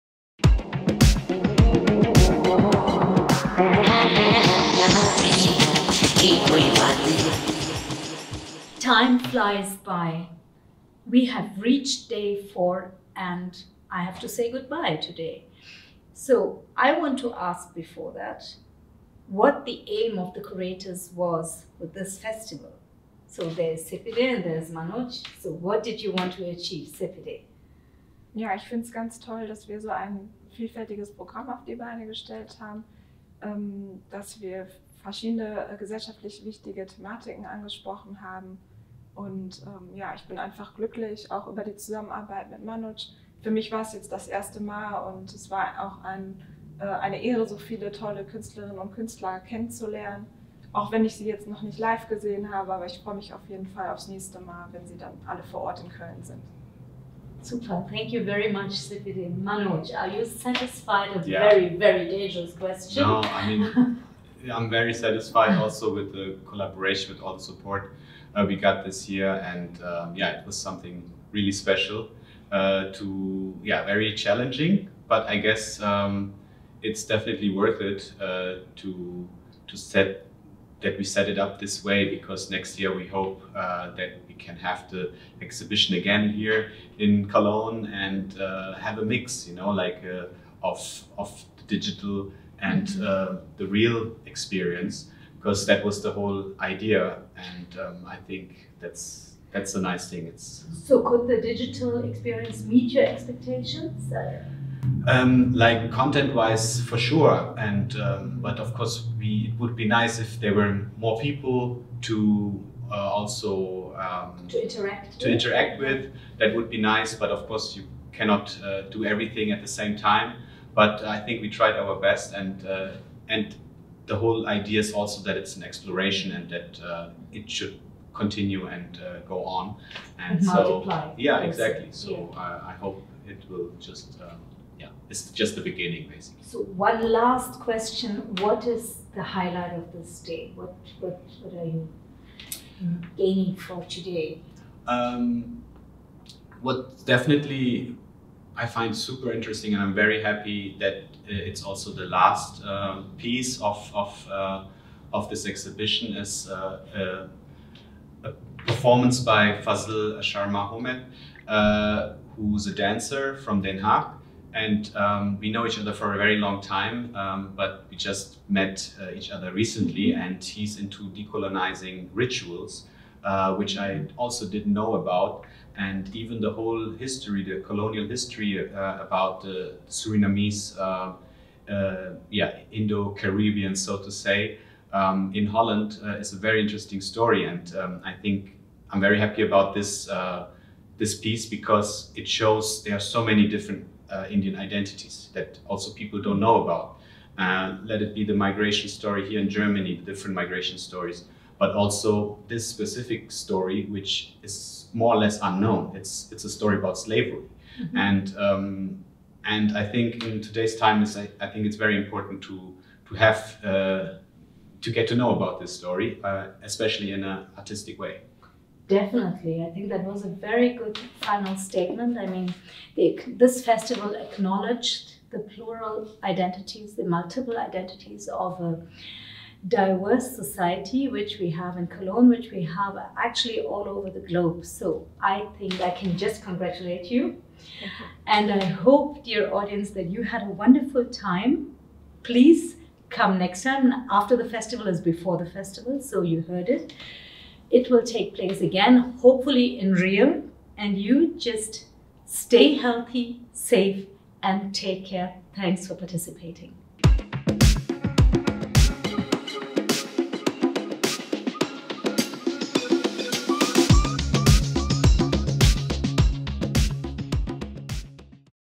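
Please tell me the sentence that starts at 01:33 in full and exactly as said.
uh, the real experience because that was the whole idea, and um, I think that's that's a nice thing.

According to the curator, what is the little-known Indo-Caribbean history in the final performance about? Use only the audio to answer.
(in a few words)
Slavery.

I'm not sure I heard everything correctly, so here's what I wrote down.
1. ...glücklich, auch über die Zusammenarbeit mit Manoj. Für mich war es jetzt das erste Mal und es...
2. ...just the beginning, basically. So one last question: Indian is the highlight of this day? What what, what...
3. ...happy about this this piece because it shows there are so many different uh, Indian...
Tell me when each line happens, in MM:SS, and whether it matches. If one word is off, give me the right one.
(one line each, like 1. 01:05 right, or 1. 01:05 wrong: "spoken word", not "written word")
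1. 00:40 right
2. 02:15 wrong: "What", not "Indian"
3. 03:09 right.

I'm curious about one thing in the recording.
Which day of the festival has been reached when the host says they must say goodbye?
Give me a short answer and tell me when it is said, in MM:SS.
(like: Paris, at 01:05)
Day four, at 00:12.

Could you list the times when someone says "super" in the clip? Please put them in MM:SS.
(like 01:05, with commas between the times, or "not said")
00:57, 02:28.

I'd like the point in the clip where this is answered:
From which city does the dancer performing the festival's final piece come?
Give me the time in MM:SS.
02:43.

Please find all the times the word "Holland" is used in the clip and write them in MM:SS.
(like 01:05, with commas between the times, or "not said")
03:05.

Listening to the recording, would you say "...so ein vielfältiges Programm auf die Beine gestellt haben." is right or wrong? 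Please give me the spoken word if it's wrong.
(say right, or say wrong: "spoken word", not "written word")
right.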